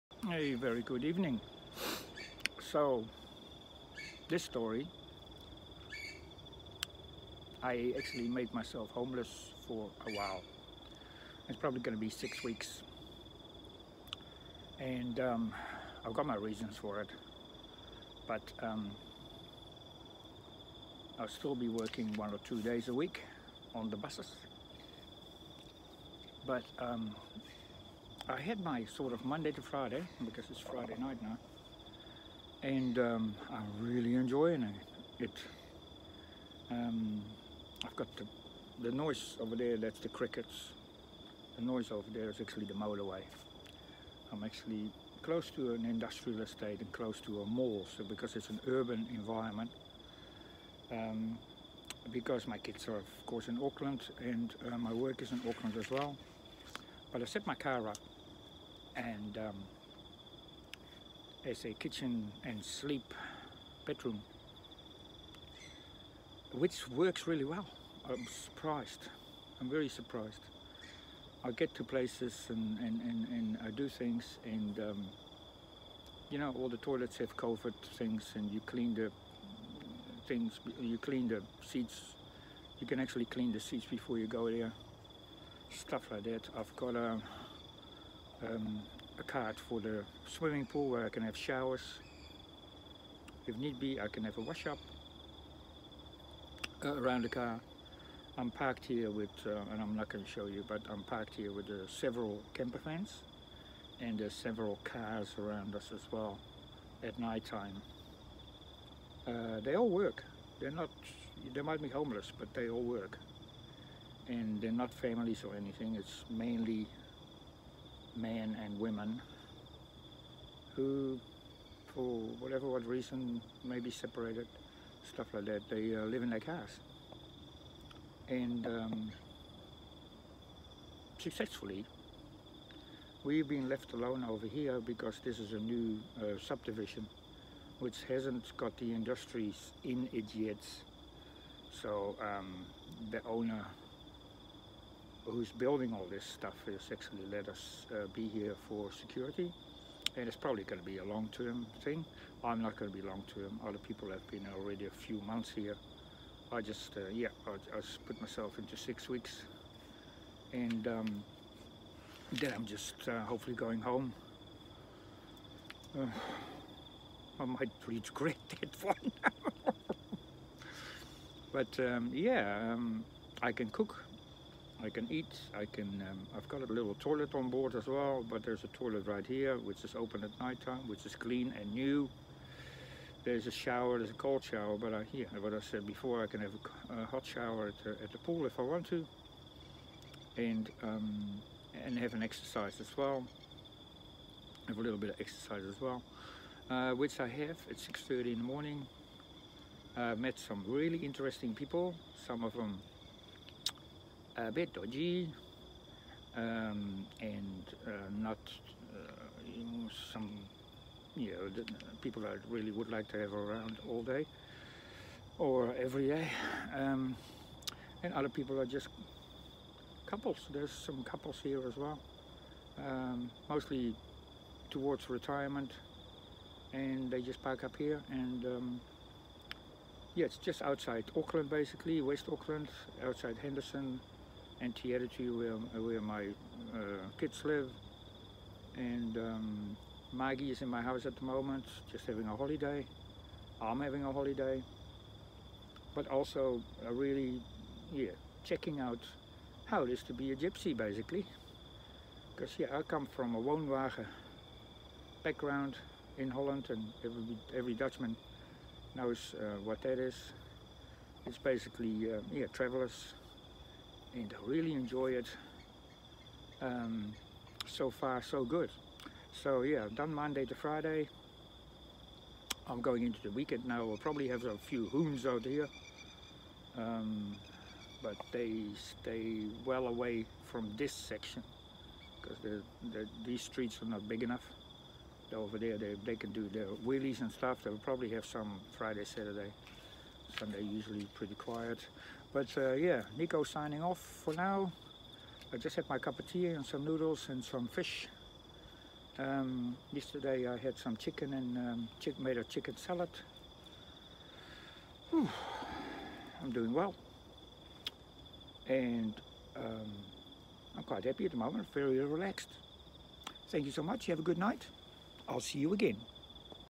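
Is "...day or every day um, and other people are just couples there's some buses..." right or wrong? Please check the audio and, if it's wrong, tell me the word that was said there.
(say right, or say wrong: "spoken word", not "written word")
wrong: "couples", not "buses".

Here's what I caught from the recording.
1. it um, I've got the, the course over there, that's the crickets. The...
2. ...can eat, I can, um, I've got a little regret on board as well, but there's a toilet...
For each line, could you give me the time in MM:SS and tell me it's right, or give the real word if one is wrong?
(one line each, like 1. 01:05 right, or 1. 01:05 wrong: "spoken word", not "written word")
1. 00:35 wrong: "noise", not "course"
2. 02:54 wrong: "toilet", not "regret".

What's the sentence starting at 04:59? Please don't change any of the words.
Um, yesterday I had some chicken and um, chick made a chicken salad.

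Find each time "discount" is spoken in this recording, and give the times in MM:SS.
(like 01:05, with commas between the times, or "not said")
not said.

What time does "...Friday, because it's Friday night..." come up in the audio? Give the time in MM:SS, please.
00:29.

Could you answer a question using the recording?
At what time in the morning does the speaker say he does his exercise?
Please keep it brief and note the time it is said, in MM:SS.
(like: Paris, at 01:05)
6.30, at 03:17.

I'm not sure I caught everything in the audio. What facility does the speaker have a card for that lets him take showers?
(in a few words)
swimming pool.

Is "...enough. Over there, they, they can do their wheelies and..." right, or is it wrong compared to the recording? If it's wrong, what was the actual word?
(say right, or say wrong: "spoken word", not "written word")
right.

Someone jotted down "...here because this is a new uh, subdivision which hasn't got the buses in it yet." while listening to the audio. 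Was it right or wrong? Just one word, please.
wrong.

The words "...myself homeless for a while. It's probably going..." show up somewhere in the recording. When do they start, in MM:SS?
00:08.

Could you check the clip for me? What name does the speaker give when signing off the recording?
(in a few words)
Nico.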